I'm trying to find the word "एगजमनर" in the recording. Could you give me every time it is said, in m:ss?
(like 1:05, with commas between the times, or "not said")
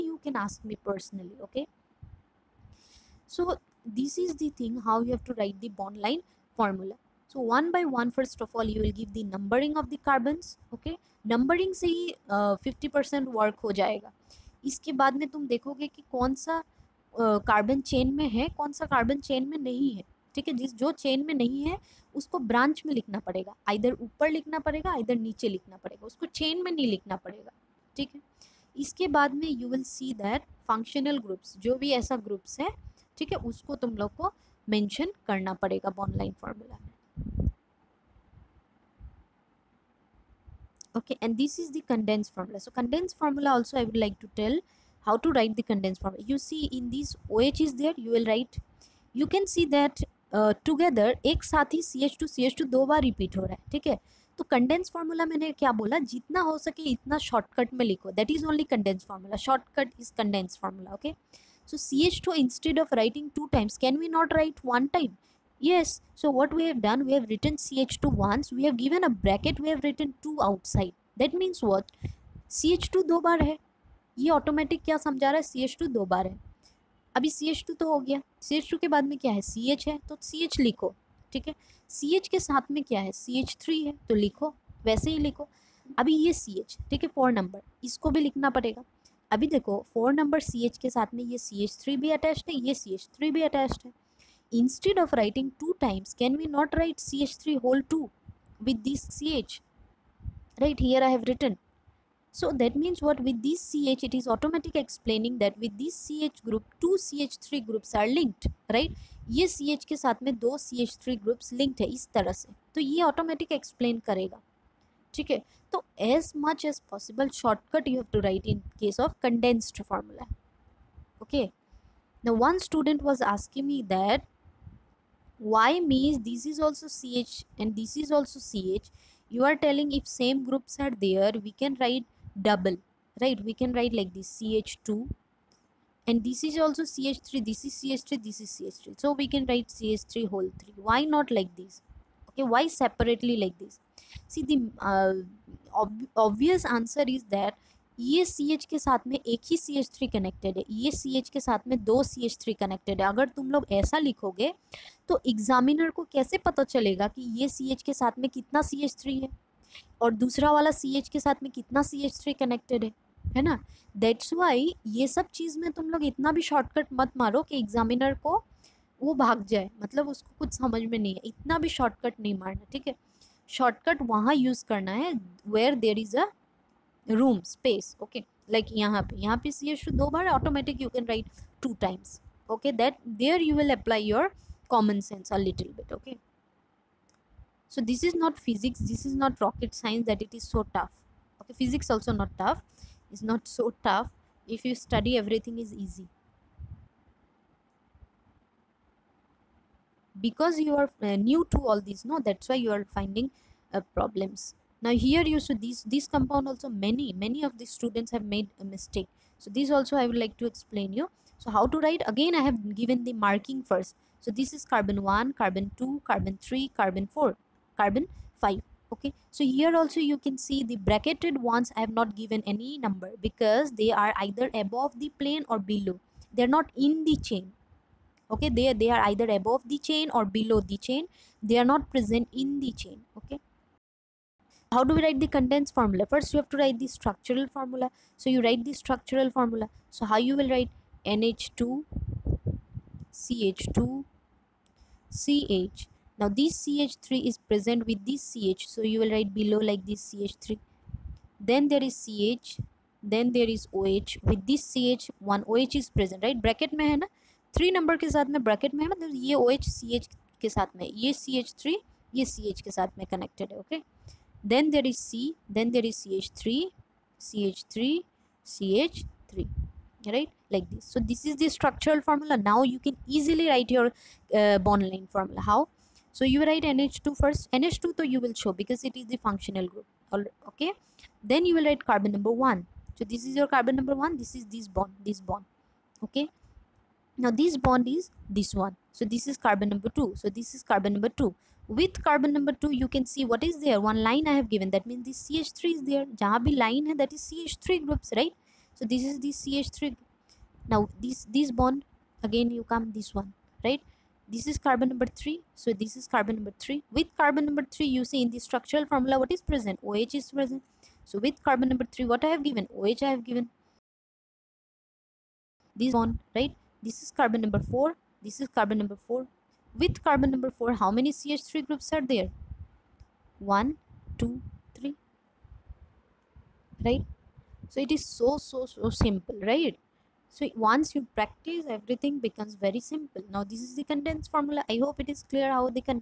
2:35, 2:47.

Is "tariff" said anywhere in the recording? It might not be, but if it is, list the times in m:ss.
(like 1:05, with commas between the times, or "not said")
not said.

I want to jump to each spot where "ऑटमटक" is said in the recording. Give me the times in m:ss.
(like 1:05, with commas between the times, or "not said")
1:14.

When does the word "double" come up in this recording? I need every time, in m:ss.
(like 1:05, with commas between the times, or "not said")
2:12.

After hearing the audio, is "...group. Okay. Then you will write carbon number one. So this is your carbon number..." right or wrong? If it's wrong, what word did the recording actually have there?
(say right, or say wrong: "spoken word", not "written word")
right.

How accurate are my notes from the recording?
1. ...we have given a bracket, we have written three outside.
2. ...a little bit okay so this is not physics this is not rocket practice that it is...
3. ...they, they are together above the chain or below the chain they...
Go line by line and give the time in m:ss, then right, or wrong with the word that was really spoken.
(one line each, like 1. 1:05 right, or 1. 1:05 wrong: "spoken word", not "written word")
1. 1:08 wrong: "two", not "three"
2. 3:05 wrong: "science", not "practice"
3. 3:48 wrong: "either", not "together".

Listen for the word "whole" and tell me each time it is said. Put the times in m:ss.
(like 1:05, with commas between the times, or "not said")
1:37, 2:20.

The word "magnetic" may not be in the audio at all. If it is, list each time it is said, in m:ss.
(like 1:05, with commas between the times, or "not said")
not said.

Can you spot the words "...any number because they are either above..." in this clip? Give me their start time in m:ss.
3:42.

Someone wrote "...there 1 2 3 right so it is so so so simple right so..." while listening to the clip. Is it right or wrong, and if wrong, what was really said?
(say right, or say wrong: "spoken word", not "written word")
right.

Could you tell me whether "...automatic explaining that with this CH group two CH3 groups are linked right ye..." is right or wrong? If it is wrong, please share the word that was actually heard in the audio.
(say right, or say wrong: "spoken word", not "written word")
right.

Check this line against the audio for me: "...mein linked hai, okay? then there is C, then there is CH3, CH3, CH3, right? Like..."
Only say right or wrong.
wrong.